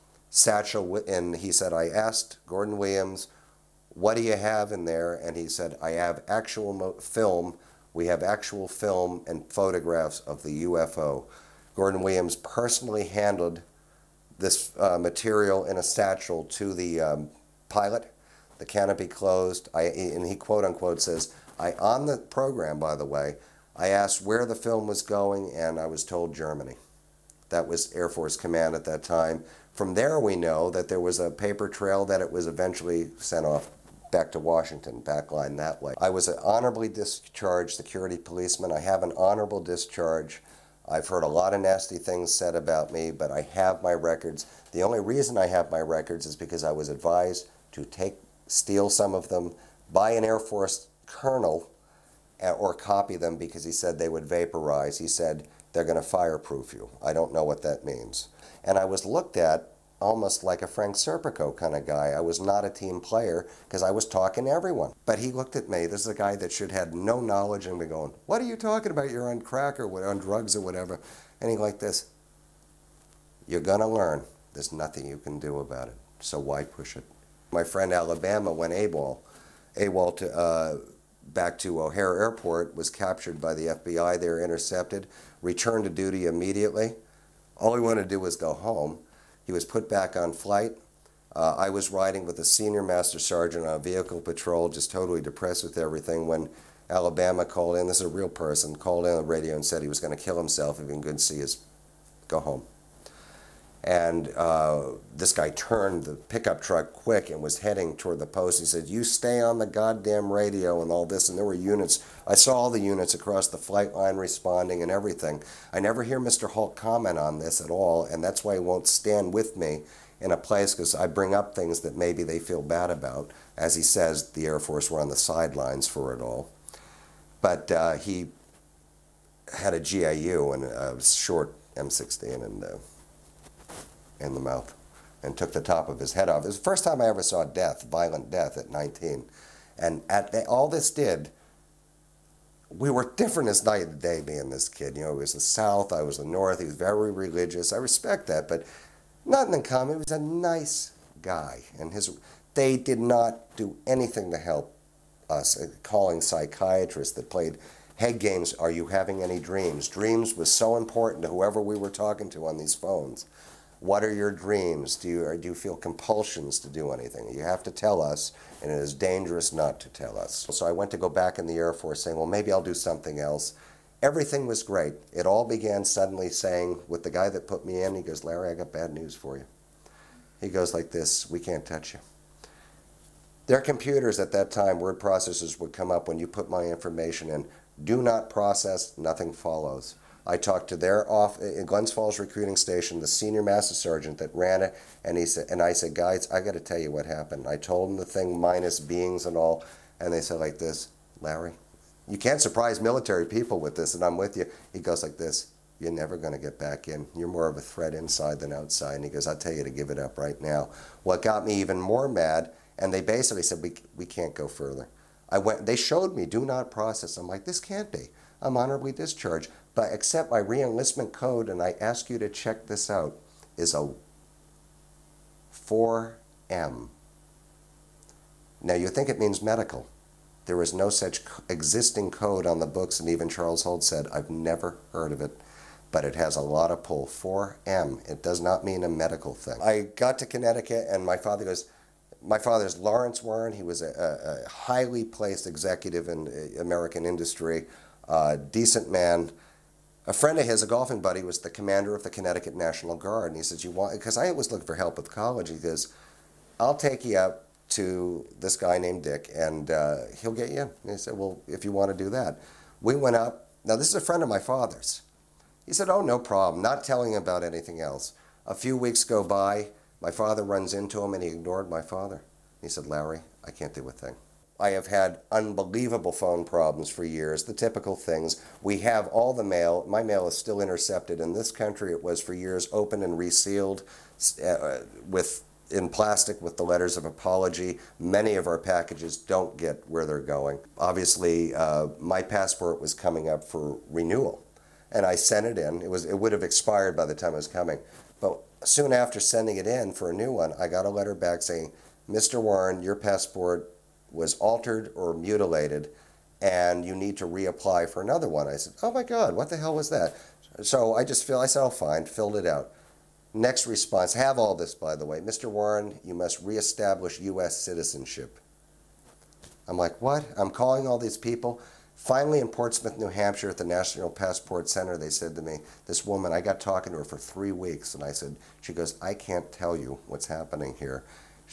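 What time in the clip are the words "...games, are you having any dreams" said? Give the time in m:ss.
2:38.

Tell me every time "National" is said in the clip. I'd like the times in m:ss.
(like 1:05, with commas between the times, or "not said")
4:12, 5:23.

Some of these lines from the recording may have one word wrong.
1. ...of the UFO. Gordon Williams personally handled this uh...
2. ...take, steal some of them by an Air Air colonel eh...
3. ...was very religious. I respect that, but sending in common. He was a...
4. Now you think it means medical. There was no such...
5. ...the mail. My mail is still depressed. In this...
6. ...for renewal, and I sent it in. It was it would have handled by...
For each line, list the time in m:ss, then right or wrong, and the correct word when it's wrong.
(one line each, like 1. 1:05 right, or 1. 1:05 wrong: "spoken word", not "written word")
1. 0:10 right
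2. 0:47 wrong: "Force", not "Air"
3. 2:26 wrong: "nothing", not "sending"
4. 3:48 right
5. 4:39 wrong: "intercepted", not "depressed"
6. 4:53 wrong: "expired", not "handled".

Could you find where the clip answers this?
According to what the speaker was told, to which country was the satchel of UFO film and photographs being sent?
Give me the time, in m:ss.
0:26.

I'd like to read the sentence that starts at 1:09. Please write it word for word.
You're on crack or on drugs or whatever.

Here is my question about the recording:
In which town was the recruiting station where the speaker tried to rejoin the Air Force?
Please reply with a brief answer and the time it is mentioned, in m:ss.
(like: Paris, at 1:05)
Glens Falls, at 3:11.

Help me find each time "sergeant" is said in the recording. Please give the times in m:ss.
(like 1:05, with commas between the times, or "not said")
1:33, 3:13.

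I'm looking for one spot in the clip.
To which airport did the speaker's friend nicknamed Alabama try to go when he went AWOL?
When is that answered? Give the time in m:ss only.
1:21.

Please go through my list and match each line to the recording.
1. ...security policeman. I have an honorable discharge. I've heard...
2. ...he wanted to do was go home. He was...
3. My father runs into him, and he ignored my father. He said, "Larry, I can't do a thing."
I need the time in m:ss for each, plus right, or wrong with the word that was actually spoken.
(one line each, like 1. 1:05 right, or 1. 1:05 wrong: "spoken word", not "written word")
1. 0:37 right
2. 1:27 right
3. 4:30 right.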